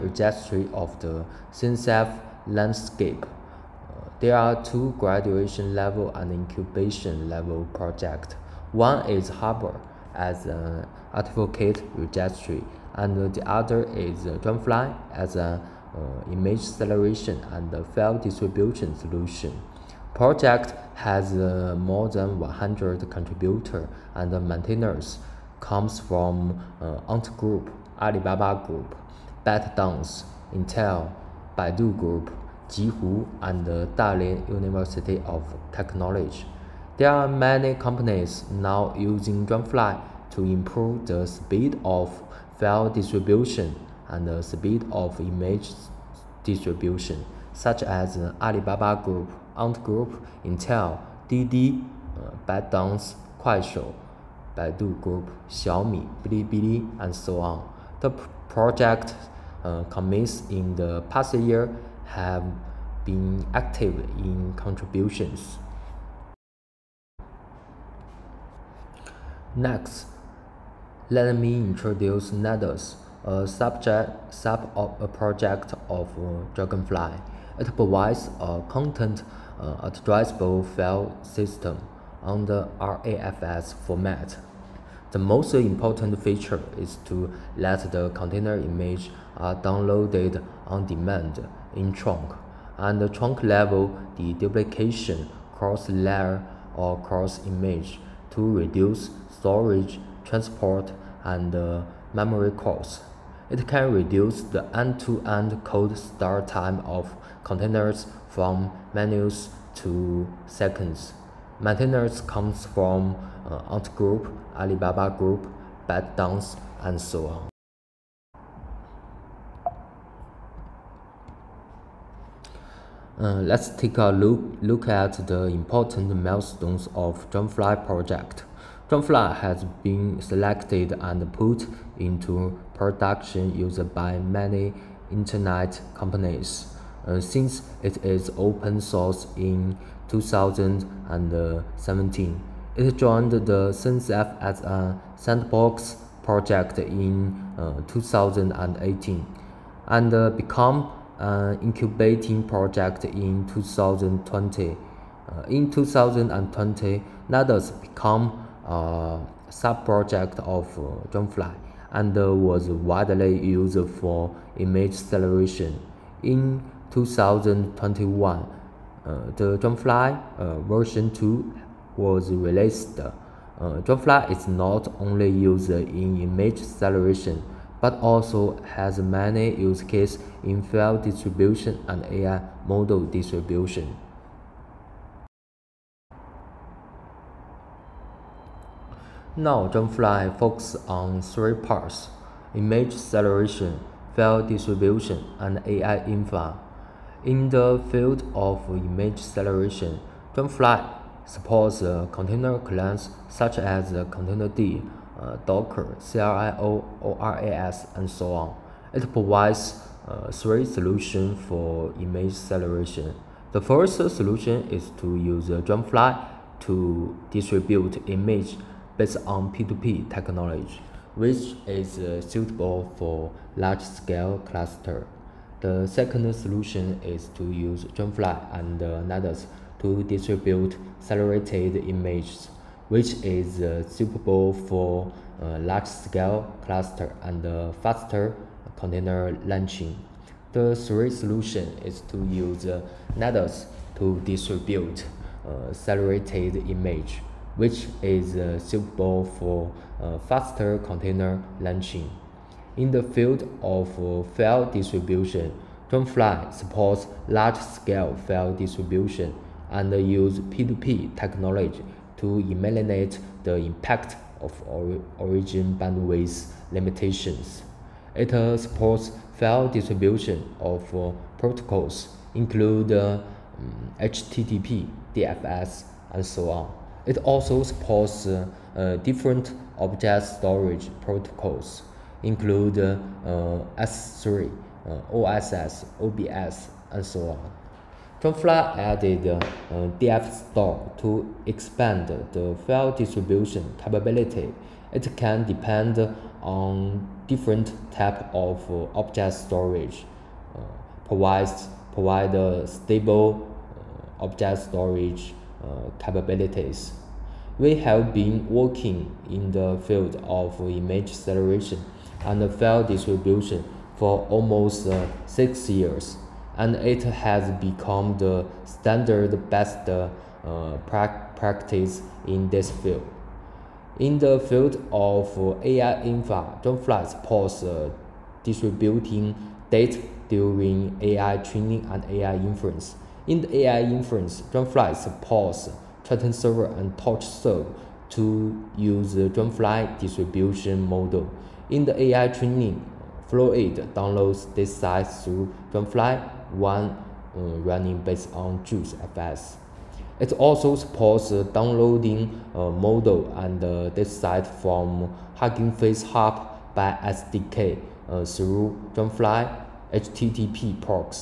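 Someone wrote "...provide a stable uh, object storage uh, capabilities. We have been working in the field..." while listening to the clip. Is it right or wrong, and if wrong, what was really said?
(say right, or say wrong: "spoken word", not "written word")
right.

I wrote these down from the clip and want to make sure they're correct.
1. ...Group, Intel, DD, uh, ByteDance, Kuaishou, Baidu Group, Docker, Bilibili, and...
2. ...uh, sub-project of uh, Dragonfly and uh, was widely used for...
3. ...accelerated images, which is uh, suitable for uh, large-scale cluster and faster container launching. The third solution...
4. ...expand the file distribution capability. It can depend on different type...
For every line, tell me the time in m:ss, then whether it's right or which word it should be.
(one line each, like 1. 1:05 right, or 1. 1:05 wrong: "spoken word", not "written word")
1. 0:49 wrong: "Xiaomi", not "Docker"
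2. 2:38 right
3. 3:50 right
4. 4:51 right.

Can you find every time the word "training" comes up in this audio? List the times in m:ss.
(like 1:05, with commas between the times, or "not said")
5:31, 5:42.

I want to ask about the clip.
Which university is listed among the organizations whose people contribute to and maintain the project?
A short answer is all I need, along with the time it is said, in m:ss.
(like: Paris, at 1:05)
Dalian University of Technology, at 0:33.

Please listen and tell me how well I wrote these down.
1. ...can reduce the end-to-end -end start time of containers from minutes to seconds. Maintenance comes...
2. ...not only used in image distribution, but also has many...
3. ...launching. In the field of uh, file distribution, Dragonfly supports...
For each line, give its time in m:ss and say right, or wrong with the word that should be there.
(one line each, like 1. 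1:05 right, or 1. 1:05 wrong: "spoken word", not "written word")
1. 1:43 right
2. 2:54 wrong: "acceleration", not "distribution"
3. 4:11 right.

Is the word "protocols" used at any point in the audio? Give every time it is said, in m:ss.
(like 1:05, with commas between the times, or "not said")
4:31, 4:41.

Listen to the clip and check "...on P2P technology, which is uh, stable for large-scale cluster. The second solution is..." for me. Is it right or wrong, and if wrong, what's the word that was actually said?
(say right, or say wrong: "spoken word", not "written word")
wrong: "suitable", not "stable".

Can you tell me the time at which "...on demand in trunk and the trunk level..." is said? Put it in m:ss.
1:30.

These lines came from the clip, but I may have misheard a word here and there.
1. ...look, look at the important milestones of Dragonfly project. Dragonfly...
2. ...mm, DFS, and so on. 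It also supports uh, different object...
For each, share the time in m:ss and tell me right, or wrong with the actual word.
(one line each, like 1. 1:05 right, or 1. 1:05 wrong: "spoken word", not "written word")
1. 2:04 right
2. 4:34 right.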